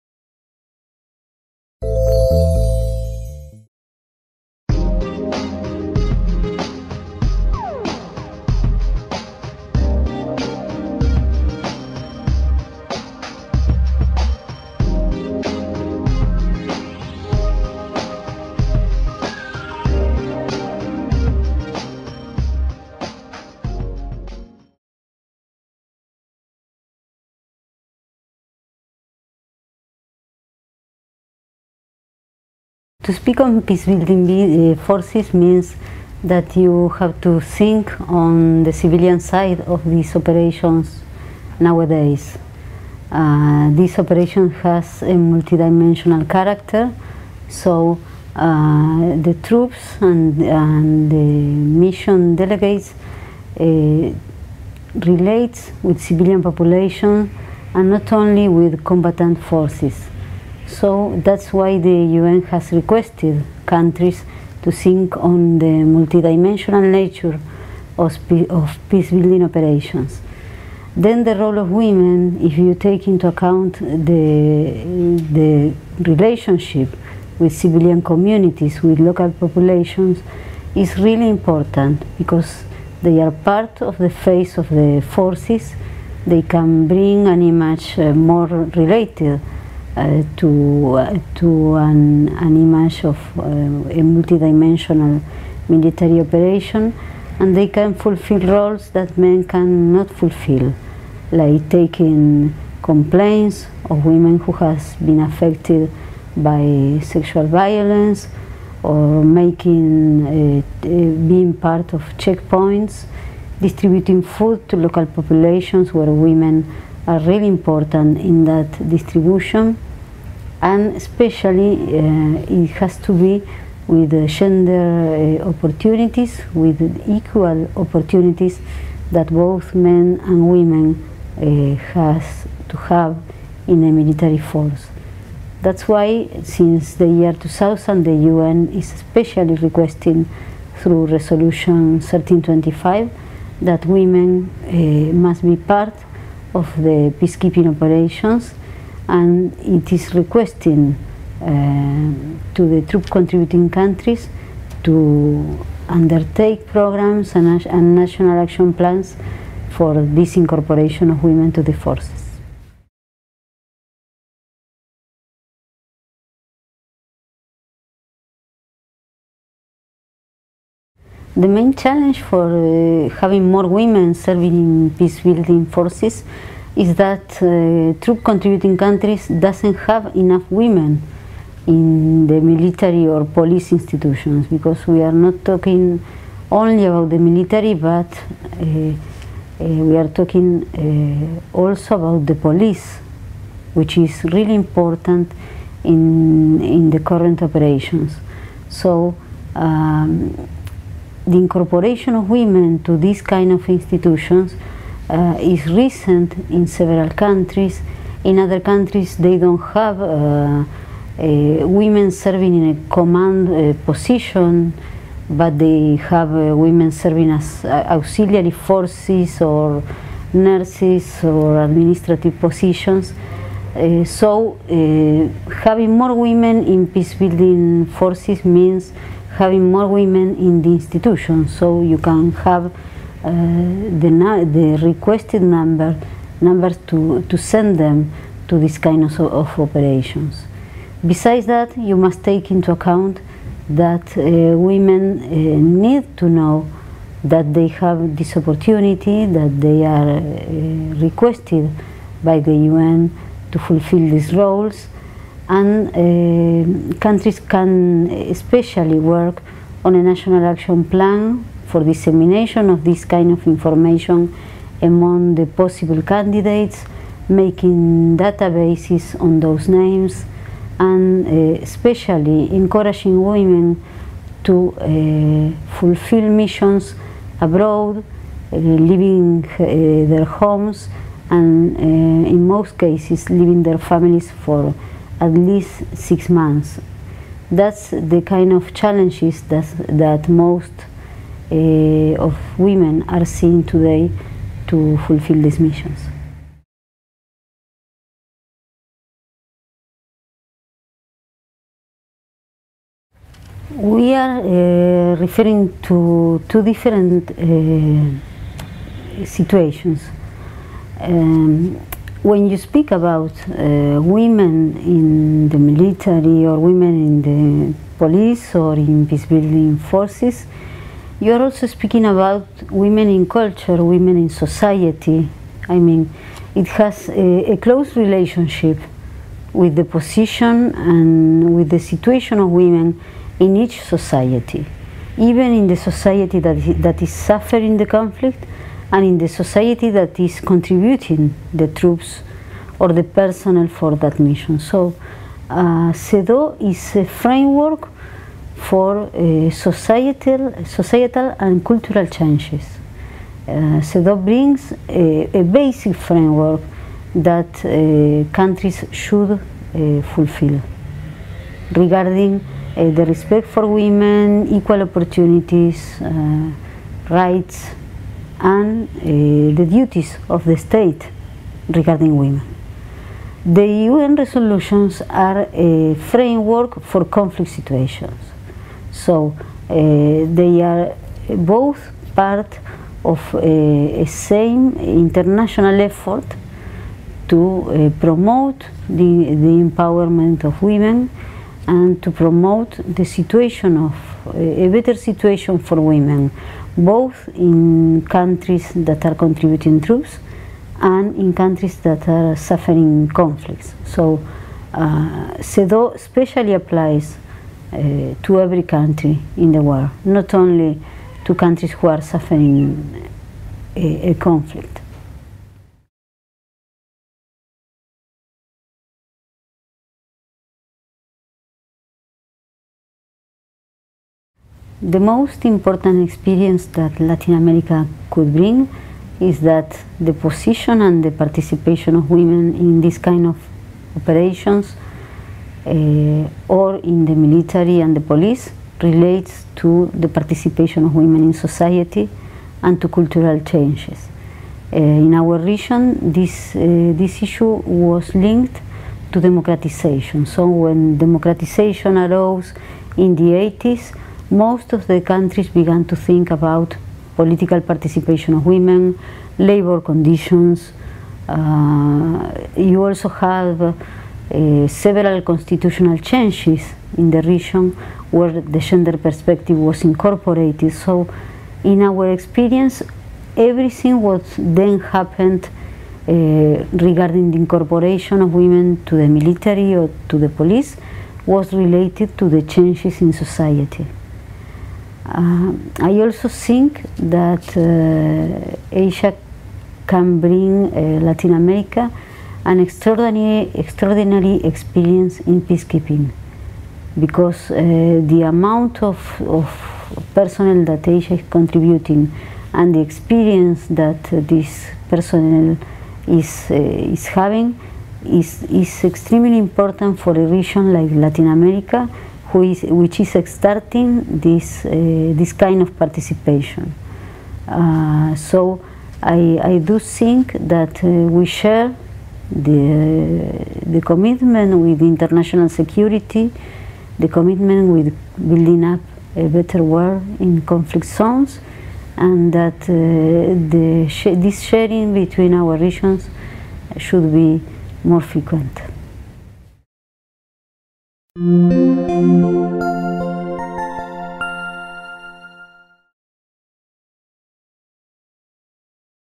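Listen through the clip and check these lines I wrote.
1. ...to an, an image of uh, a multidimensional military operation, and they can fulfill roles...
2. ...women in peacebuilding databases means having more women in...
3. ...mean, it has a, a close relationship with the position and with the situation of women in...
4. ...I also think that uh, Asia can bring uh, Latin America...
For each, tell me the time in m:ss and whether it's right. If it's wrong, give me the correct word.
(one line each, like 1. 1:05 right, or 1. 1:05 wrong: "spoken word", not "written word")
1. 1:31 right
2. 3:46 wrong: "forces", not "databases"
3. 5:25 right
4. 8:05 right.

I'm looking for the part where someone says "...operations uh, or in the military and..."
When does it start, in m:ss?
7:13.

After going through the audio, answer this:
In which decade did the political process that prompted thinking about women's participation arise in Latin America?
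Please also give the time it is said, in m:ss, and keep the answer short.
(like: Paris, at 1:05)
The 80s, at 7:33.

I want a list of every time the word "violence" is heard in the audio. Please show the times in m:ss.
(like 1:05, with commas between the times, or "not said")
1:47.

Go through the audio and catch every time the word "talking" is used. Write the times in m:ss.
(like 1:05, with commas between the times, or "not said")
3:05, 3:10.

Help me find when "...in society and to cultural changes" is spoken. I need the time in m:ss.
7:21.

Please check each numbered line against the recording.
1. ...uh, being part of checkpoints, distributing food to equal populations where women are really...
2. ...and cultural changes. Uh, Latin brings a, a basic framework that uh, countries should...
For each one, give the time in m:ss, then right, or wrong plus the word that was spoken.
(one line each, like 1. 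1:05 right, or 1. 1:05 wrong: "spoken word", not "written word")
1. 1:50 wrong: "local", not "equal"
2. 5:51 wrong: "CEDAW", not "Latin".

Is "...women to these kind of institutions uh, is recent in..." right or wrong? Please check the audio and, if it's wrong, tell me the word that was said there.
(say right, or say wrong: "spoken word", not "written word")
right.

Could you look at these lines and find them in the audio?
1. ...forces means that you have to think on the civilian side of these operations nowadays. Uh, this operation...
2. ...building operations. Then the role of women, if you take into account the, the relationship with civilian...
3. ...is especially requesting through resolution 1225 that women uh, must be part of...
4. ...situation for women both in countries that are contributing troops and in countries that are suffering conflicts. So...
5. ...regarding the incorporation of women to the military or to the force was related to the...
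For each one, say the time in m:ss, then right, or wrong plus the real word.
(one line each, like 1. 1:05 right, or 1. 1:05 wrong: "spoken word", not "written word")
1. 0:34 right
2. 1:09 right
3. 2:18 wrong: "1325", not "1225"
4. 6:34 right
5. 7:56 wrong: "police", not "force".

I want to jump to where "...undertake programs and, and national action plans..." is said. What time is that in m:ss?
2:35.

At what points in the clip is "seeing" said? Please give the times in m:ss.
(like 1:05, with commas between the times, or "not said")
4:53.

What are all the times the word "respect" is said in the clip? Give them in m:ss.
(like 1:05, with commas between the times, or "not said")
6:03.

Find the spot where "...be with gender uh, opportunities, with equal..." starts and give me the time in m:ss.
2:03.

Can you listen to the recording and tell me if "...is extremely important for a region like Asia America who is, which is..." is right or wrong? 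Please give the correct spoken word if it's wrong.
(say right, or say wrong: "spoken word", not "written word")
wrong: "Latin", not "Asia".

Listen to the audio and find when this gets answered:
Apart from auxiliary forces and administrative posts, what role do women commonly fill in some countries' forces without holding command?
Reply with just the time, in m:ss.
3:40.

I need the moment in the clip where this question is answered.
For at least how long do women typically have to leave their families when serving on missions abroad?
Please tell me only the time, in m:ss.
4:45.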